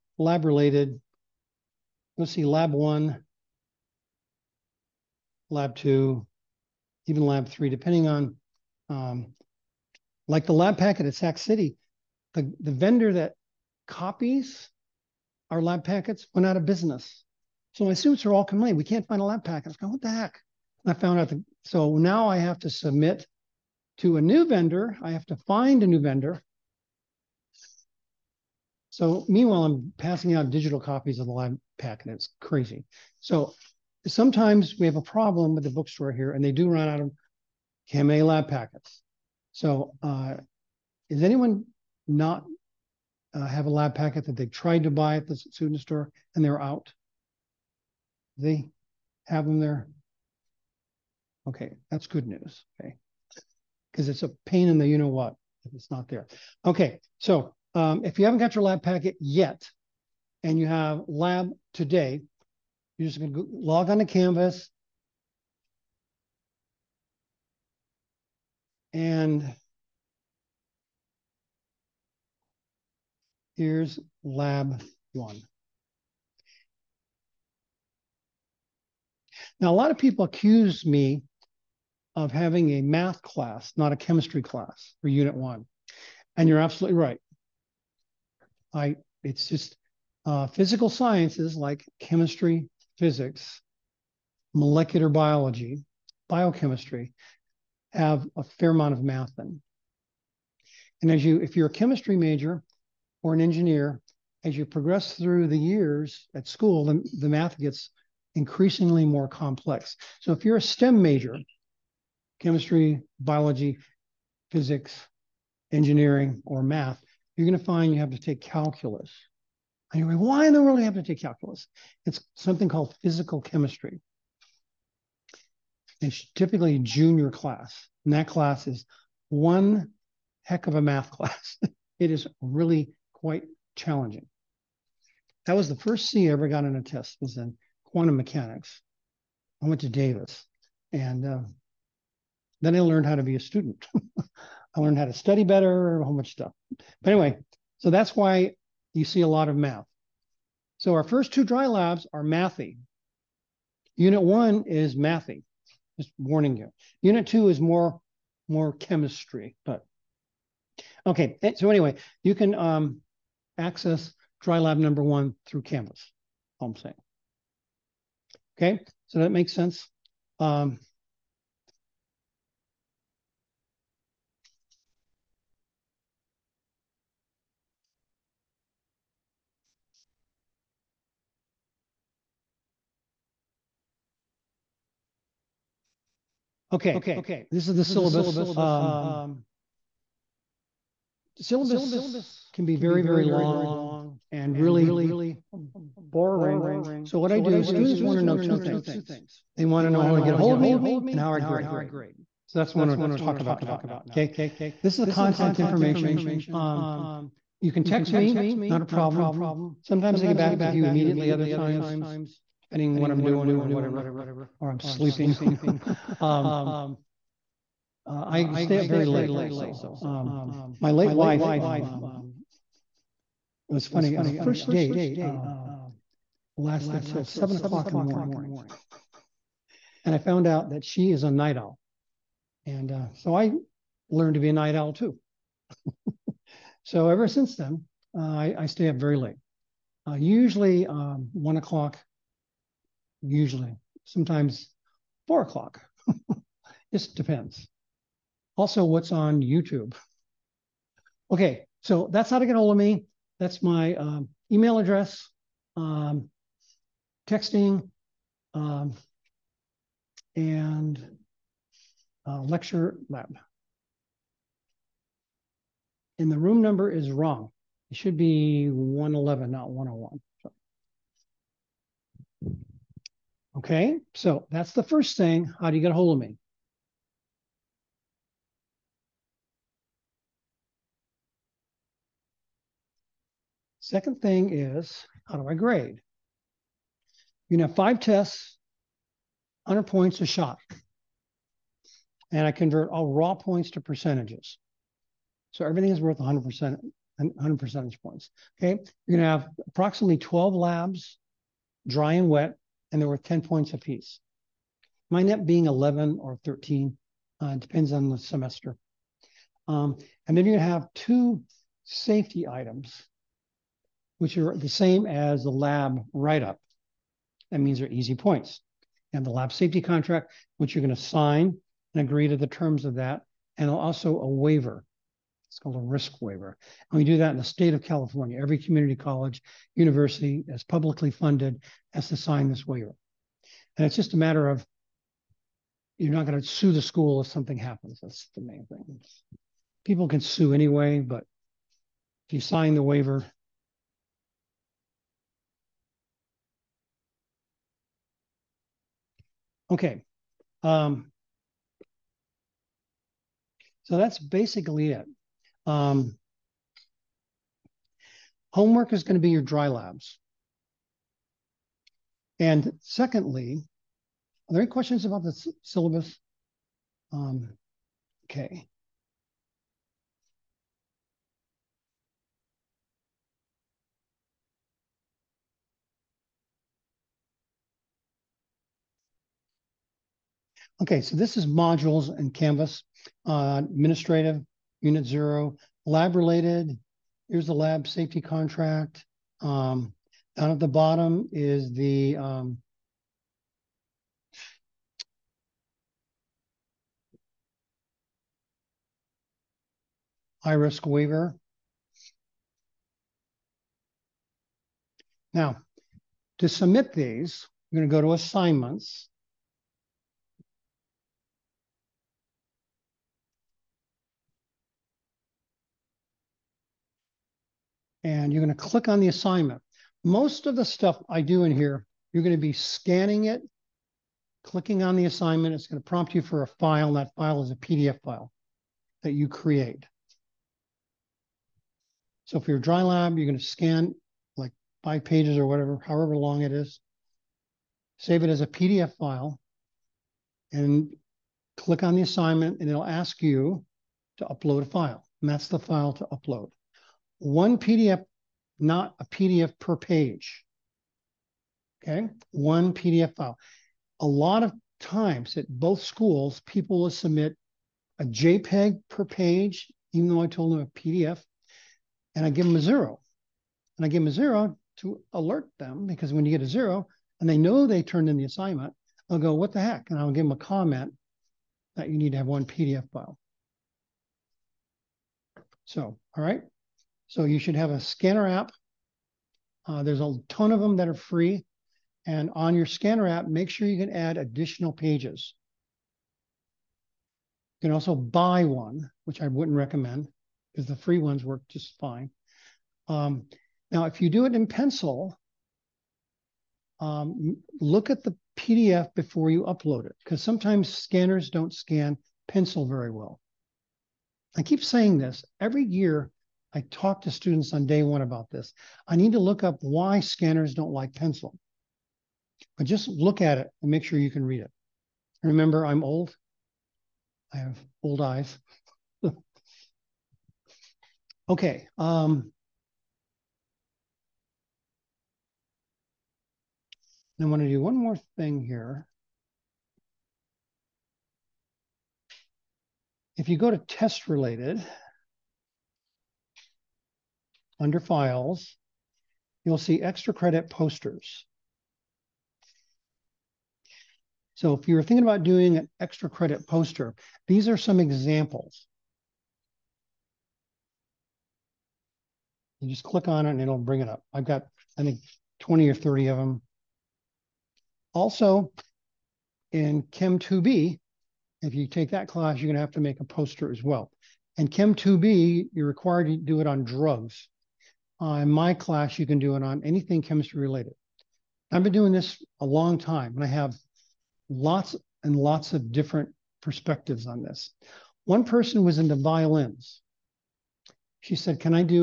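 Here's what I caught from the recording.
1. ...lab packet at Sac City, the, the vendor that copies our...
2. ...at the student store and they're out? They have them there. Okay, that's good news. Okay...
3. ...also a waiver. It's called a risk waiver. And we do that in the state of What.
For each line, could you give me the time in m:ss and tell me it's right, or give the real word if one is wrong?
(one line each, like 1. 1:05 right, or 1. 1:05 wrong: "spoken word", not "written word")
1. 0:10 right
2. 0:45 right
3. 5:23 wrong: "California", not "What".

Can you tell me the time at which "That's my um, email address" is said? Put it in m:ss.
4:13.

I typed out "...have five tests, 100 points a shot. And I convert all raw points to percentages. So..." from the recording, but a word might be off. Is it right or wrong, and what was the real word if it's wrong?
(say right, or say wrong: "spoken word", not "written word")
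right.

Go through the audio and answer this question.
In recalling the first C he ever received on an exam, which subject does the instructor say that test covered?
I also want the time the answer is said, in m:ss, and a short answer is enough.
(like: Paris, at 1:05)
quantum mechanics, at 2:17.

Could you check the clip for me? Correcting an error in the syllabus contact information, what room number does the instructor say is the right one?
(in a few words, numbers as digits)
111.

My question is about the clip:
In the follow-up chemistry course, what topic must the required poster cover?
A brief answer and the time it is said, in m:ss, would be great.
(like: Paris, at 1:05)
drugs, at 9:26.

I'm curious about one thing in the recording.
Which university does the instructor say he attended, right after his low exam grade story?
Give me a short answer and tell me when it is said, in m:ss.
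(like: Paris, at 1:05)
Davis, at 2:19.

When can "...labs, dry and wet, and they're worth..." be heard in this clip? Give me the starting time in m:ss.
5:00.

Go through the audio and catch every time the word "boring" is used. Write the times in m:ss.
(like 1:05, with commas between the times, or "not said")
3:16.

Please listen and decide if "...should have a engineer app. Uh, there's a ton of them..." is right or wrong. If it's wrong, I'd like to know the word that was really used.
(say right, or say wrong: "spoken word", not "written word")
wrong: "scanner", not "engineer".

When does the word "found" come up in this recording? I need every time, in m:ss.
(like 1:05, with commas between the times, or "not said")
0:20, 3:50.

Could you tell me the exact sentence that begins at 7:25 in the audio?
And that's the file to upload one PDF, not a PDF per page.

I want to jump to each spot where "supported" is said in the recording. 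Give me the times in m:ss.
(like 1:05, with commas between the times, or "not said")
not said.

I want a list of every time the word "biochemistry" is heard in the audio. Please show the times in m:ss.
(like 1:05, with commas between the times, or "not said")
1:36.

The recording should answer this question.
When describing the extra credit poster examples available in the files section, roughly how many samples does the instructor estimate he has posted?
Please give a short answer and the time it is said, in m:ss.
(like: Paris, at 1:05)
20 or 30, at 9:15.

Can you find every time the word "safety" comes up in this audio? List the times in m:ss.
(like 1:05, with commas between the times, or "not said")
5:11, 5:19, 6:27.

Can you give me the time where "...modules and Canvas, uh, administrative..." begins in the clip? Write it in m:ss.
6:21.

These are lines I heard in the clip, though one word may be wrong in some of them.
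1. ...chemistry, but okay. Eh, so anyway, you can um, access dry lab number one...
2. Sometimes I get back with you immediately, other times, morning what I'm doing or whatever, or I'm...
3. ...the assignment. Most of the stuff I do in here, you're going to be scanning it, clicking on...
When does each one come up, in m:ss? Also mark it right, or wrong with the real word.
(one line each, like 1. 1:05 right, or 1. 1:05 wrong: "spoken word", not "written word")
1. 2:38 right
2. 3:29 wrong: "depending", not "morning"
3. 6:58 right.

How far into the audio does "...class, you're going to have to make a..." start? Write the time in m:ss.
9:22.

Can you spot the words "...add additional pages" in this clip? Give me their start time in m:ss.
8:03.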